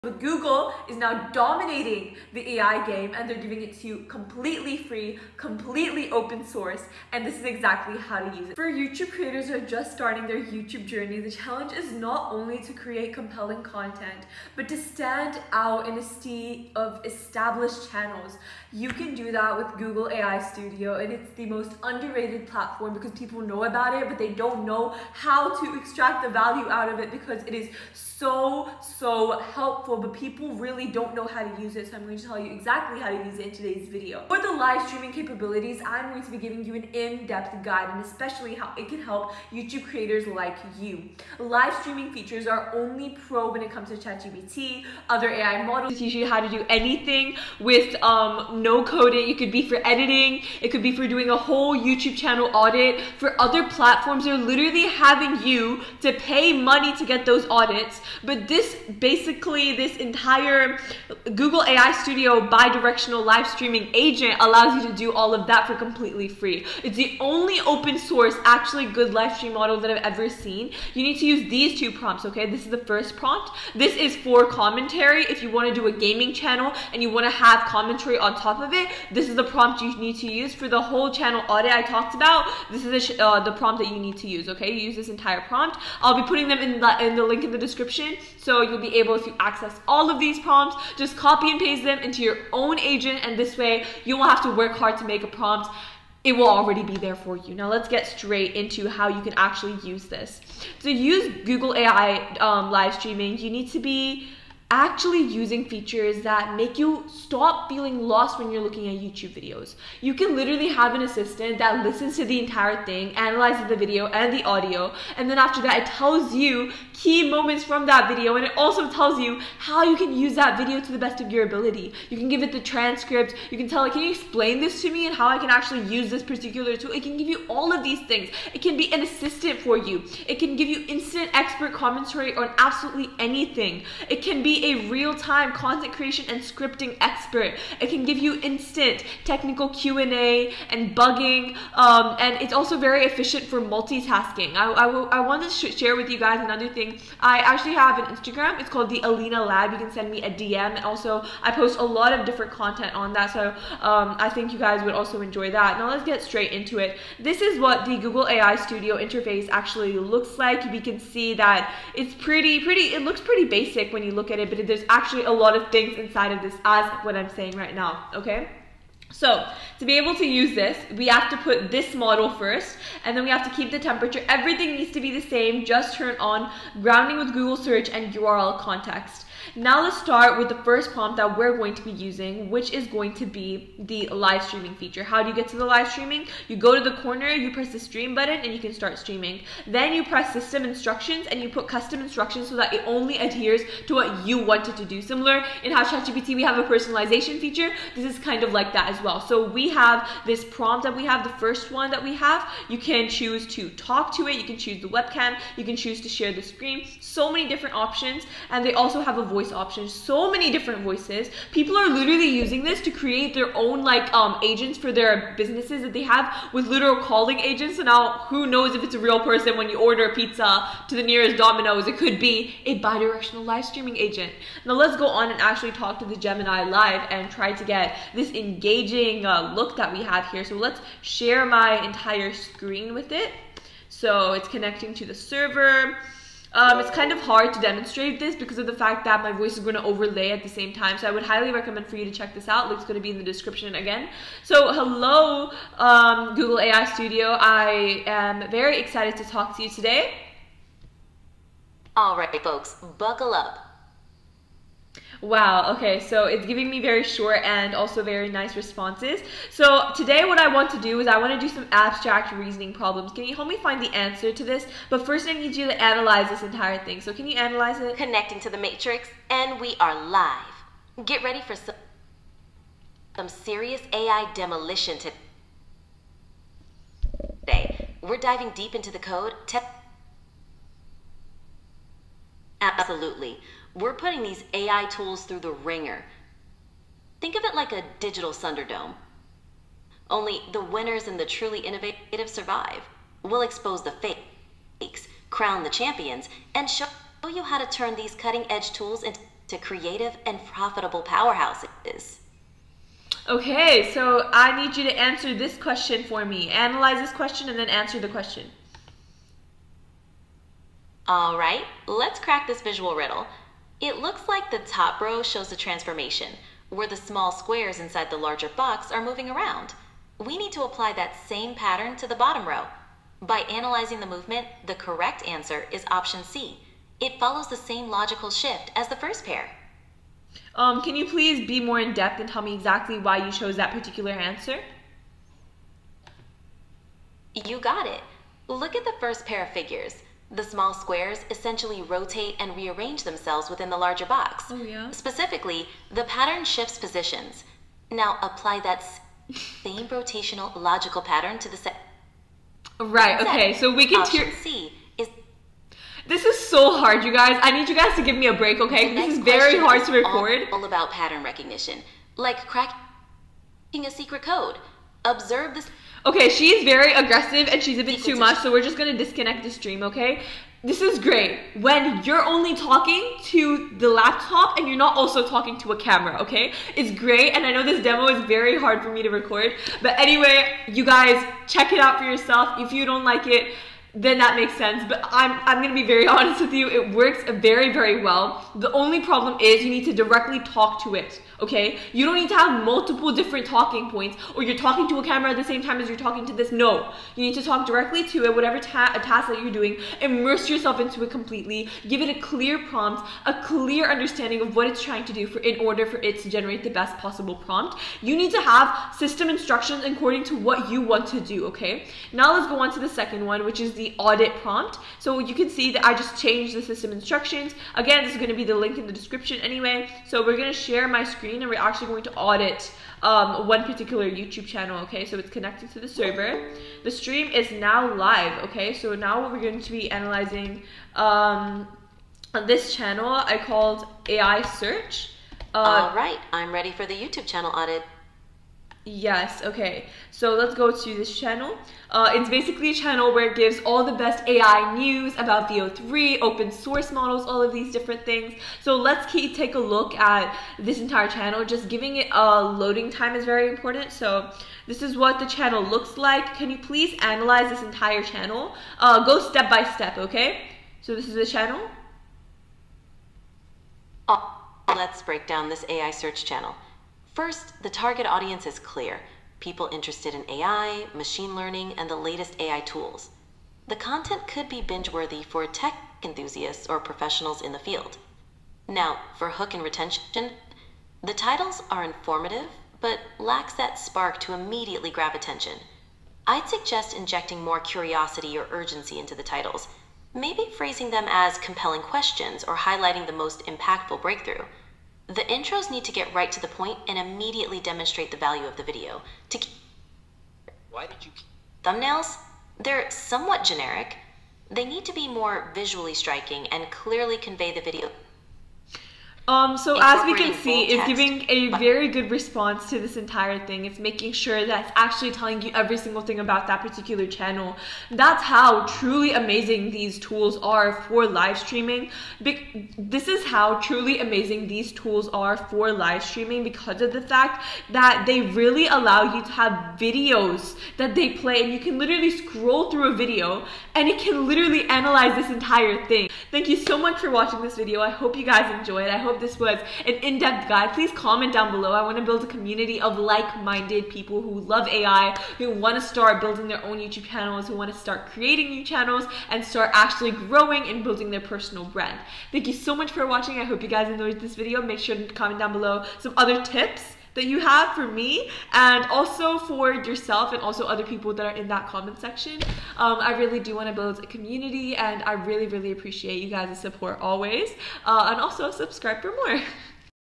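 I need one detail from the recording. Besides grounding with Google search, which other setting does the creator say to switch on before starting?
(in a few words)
URL context.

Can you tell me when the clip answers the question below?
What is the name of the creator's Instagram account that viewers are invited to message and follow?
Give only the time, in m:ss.
2:28.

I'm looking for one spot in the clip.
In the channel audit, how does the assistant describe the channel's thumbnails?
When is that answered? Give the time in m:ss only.
8:22.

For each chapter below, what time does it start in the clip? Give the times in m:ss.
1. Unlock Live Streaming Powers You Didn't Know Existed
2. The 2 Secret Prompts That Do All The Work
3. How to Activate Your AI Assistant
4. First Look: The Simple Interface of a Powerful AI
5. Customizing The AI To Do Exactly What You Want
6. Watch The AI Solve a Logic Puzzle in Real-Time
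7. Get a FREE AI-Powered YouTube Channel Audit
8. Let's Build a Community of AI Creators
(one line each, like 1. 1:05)
1. 0:34
2. 1:10
3. 1:38
4. 2:36
5. 3:02
6. 4:20
7. 6:52
8. 8:56.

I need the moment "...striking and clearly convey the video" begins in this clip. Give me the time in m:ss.
8:25.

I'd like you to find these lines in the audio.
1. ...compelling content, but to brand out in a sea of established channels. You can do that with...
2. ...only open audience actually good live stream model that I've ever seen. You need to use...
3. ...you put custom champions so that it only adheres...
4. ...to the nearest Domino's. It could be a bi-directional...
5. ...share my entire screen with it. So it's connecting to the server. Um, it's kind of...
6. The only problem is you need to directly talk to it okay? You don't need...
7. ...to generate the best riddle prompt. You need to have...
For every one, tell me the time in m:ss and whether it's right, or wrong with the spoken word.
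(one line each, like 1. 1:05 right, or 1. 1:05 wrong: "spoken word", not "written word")
1. 0:13 wrong: "stand", not "brand"
2. 1:07 wrong: "source", not "audience"
3. 3:11 wrong: "instructions", not "champions"
4. 3:40 right
5. 3:51 right
6. 6:28 right
7. 6:46 wrong: "possible", not "riddle".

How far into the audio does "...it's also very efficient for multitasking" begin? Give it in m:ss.
2:22.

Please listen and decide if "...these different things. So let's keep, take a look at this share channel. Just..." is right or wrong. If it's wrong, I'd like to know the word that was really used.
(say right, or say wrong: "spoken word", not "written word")
wrong: "entire", not "share".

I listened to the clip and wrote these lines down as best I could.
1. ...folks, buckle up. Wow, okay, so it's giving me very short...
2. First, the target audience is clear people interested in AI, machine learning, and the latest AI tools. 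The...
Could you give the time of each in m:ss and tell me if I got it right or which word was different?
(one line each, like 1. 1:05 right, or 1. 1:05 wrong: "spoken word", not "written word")
1. 4:12 right
2. 7:47 right.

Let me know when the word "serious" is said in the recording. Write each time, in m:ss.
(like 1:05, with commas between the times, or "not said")
4:33.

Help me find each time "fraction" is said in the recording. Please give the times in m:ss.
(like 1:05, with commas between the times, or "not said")
not said.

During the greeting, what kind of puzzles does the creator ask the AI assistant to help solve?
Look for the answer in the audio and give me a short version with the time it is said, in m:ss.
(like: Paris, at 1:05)
Abstract reasoning problems, at 4:21.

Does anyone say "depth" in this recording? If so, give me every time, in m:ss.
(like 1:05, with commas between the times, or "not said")
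0:36, 5:31, 9:00.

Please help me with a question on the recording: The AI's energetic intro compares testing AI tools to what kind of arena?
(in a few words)
Digital Thunderdome.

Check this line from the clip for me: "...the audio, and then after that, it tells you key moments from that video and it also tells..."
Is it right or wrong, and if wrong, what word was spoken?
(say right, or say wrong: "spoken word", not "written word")
right.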